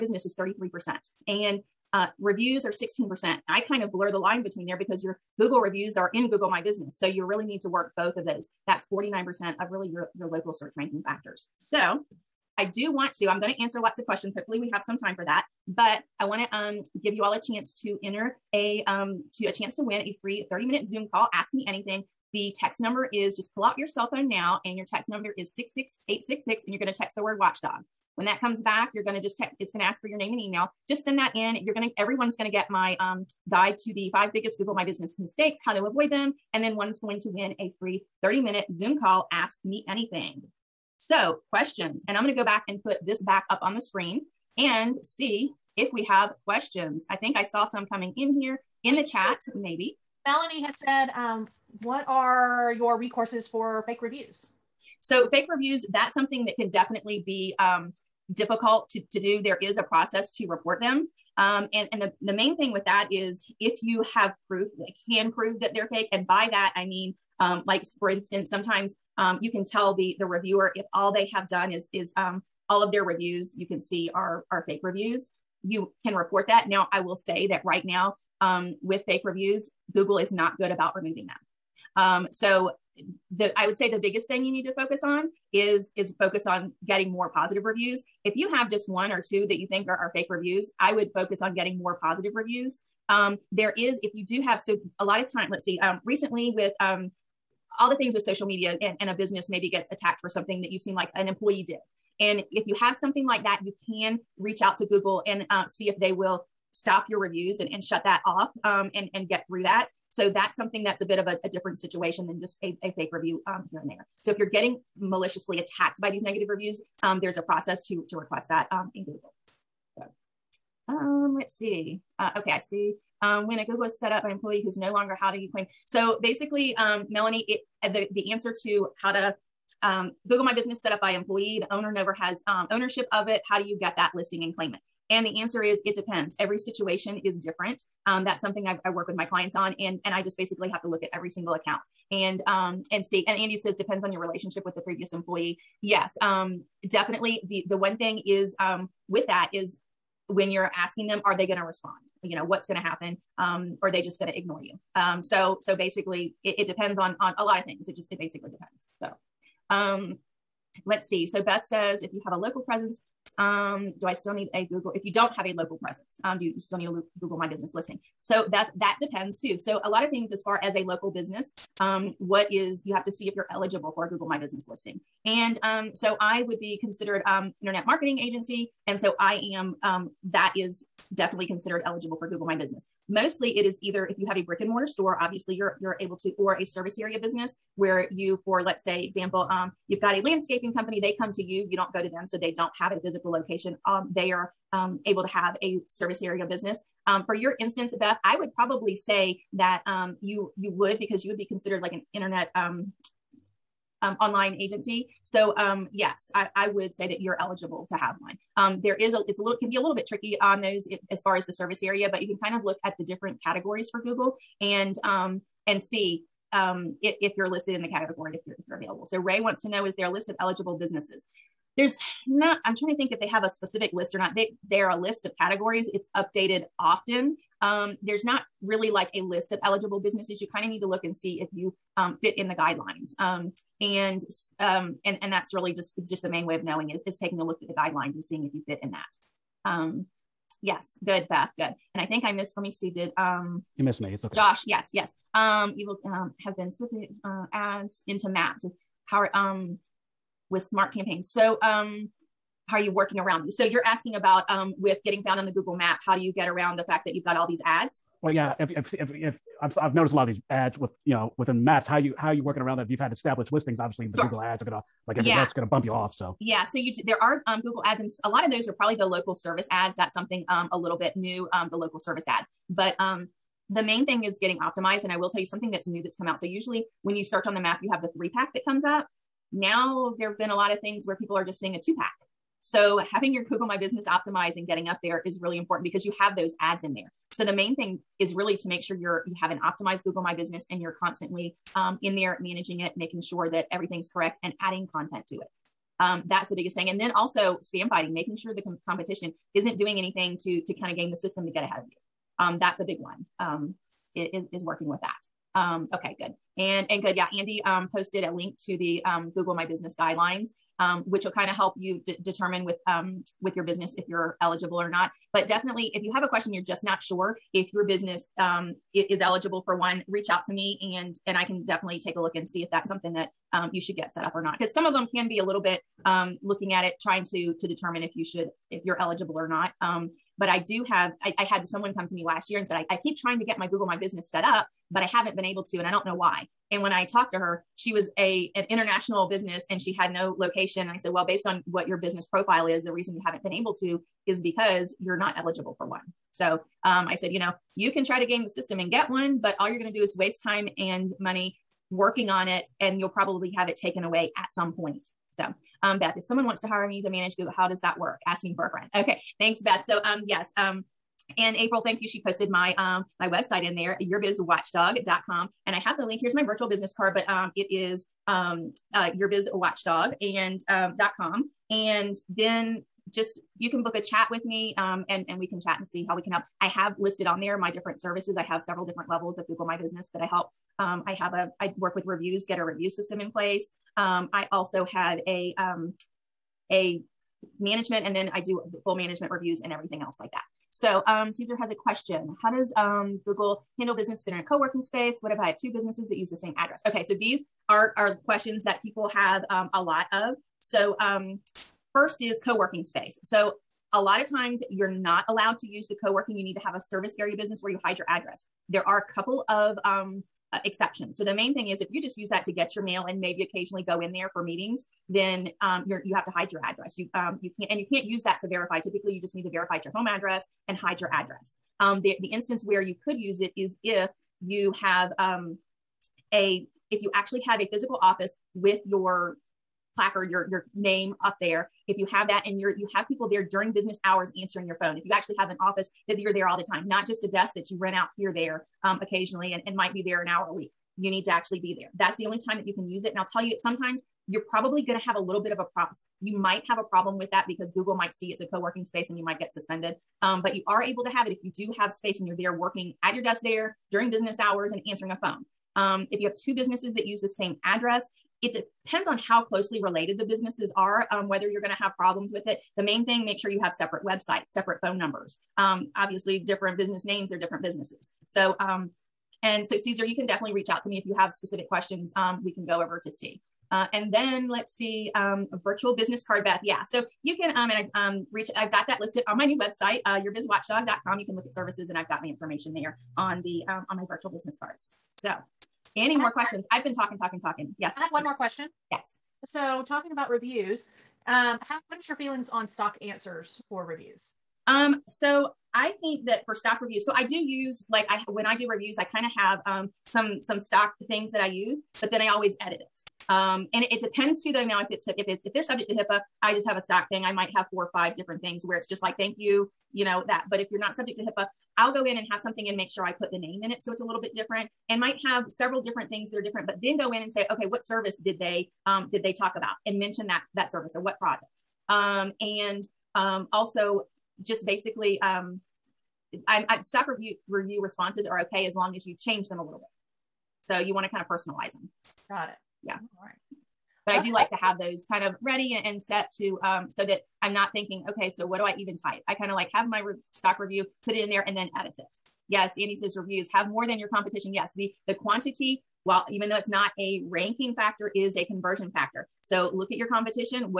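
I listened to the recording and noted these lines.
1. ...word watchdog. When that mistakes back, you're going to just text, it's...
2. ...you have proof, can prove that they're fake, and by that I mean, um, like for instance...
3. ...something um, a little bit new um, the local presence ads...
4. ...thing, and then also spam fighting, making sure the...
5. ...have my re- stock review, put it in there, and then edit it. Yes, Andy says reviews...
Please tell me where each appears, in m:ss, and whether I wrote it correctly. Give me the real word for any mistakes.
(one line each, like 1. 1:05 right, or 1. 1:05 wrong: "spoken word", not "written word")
1. 0:27 wrong: "comes", not "mistakes"
2. 1:03 right
3. 4:30 wrong: "service", not "presence"
4. 4:56 right
5. 8:59 right.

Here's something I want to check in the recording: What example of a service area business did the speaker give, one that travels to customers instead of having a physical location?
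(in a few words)
landscaping company.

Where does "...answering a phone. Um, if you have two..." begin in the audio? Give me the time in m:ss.
7:34.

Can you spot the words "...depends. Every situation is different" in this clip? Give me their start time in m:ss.
2:15.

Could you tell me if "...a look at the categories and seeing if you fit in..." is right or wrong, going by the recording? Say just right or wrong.
wrong.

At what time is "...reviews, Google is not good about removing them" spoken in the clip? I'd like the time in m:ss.
1:19.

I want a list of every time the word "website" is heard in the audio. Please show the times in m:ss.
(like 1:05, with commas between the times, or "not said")
6:03, 7:44, 7:59.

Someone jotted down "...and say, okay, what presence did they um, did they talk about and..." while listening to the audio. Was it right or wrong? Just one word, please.
wrong.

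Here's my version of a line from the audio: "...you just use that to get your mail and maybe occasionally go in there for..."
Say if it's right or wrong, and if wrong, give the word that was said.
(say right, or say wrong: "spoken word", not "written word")
right.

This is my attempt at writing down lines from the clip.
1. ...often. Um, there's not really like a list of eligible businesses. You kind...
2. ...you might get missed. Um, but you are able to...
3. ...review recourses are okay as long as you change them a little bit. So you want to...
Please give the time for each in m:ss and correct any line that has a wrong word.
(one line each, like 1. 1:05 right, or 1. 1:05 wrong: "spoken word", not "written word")
1. 3:46 right
2. 7:29 wrong: "suspended", not "missed"
3. 8:47 wrong: "responses", not "recourses".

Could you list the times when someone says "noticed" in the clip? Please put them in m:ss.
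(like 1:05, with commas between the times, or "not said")
4:19.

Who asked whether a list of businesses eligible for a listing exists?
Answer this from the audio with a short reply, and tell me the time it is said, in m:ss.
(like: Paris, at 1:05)
Ray, at 3:39.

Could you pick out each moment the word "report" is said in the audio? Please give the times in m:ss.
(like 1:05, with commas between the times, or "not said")
1:00, 1:16.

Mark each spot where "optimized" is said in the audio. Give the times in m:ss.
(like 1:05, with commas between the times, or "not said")
4:34, 4:44, 4:49.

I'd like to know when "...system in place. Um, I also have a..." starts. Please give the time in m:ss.
6:22.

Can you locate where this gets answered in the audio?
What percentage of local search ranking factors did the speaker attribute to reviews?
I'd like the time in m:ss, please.
0:02.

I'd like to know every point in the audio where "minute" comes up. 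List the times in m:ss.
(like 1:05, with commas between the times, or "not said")
0:20, 0:38.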